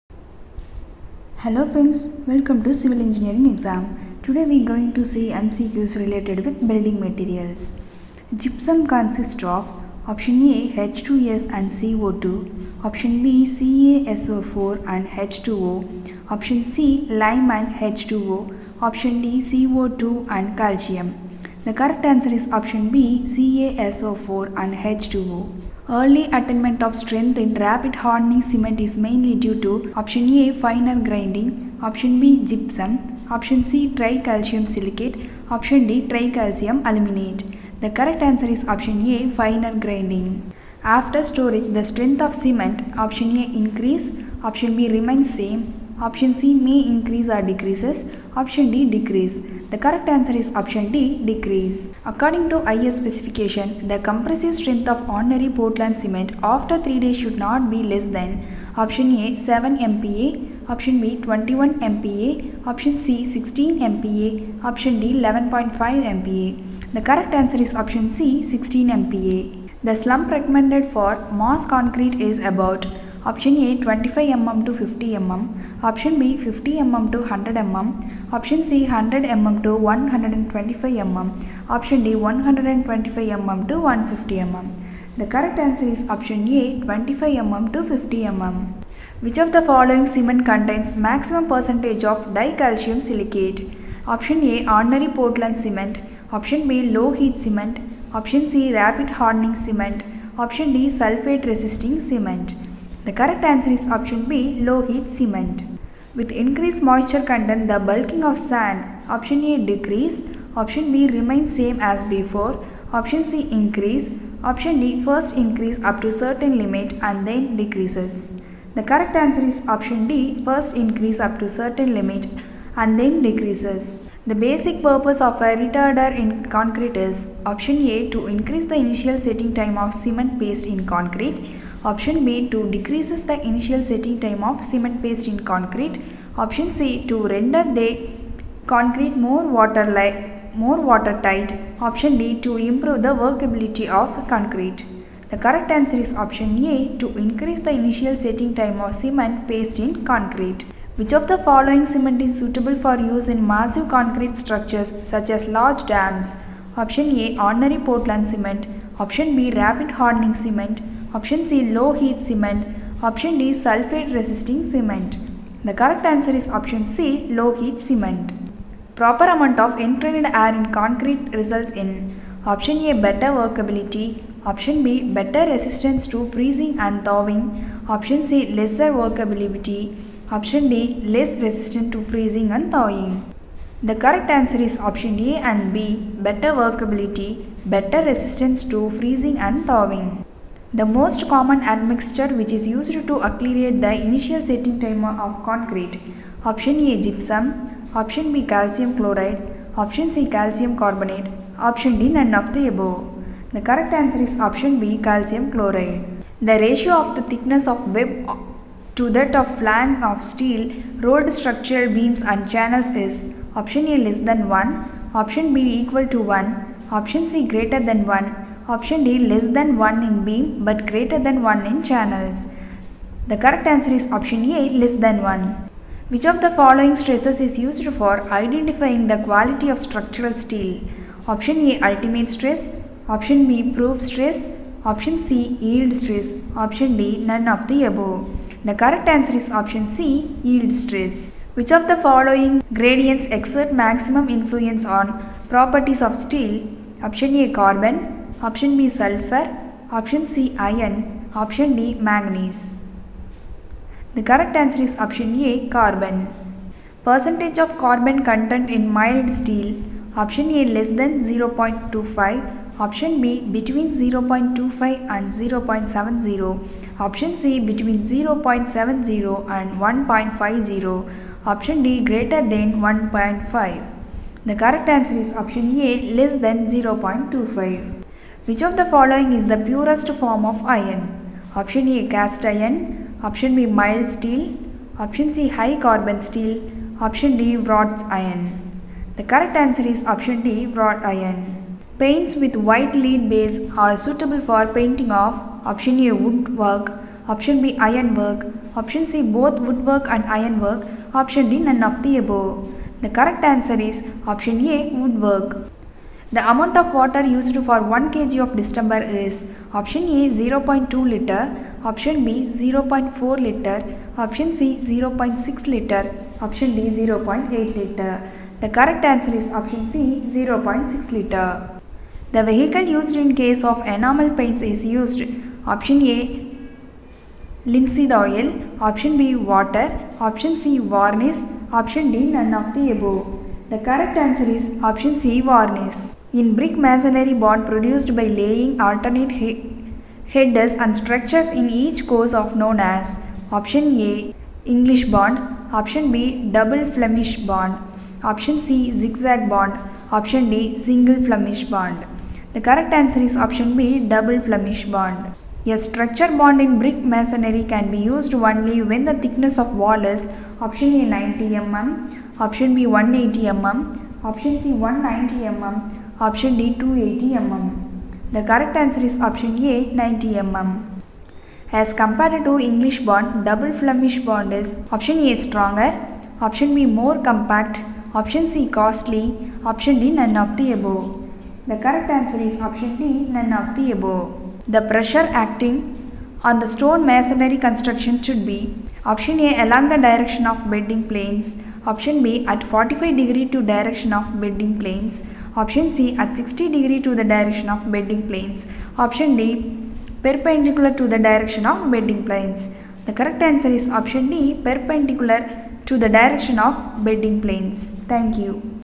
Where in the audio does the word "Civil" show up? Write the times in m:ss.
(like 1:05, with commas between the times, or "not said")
0:02.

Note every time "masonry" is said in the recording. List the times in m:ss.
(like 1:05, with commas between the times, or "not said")
5:36, 5:57, 6:27.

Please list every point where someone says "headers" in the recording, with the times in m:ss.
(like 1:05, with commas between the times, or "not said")
5:40.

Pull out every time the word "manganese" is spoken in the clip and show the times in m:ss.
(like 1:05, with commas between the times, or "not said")
4:12.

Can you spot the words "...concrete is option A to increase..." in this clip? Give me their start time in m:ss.
2:06.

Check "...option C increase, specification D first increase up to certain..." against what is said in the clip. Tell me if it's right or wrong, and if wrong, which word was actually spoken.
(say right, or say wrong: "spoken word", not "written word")
wrong: "option", not "specification".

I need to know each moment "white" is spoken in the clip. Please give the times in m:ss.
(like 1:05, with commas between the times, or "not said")
4:52.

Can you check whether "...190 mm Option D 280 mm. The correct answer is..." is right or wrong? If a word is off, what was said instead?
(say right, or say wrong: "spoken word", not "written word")
right.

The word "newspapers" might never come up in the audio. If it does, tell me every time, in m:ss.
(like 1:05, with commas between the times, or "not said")
not said.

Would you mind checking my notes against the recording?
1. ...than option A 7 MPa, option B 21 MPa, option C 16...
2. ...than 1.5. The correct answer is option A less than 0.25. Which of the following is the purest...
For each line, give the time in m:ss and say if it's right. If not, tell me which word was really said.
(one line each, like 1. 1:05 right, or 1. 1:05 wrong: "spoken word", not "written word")
1. 0:58 right
2. 4:32 right.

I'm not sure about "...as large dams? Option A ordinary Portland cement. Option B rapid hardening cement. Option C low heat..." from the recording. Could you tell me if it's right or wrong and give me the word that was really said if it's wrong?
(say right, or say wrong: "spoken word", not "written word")
right.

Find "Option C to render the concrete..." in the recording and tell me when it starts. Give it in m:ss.
2:16.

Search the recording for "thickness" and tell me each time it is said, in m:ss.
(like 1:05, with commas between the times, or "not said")
3:27, 5:59.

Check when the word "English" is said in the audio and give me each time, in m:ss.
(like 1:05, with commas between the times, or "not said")
5:44, 6:12.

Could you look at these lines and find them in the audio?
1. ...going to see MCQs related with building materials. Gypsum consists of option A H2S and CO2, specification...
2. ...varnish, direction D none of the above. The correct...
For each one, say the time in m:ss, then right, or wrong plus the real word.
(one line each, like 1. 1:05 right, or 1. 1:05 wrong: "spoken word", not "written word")
1. 0:04 wrong: "option", not "specification"
2. 5:30 wrong: "option", not "direction".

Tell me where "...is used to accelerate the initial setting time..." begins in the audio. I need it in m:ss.
3:12.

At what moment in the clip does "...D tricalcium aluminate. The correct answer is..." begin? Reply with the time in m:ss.
0:35.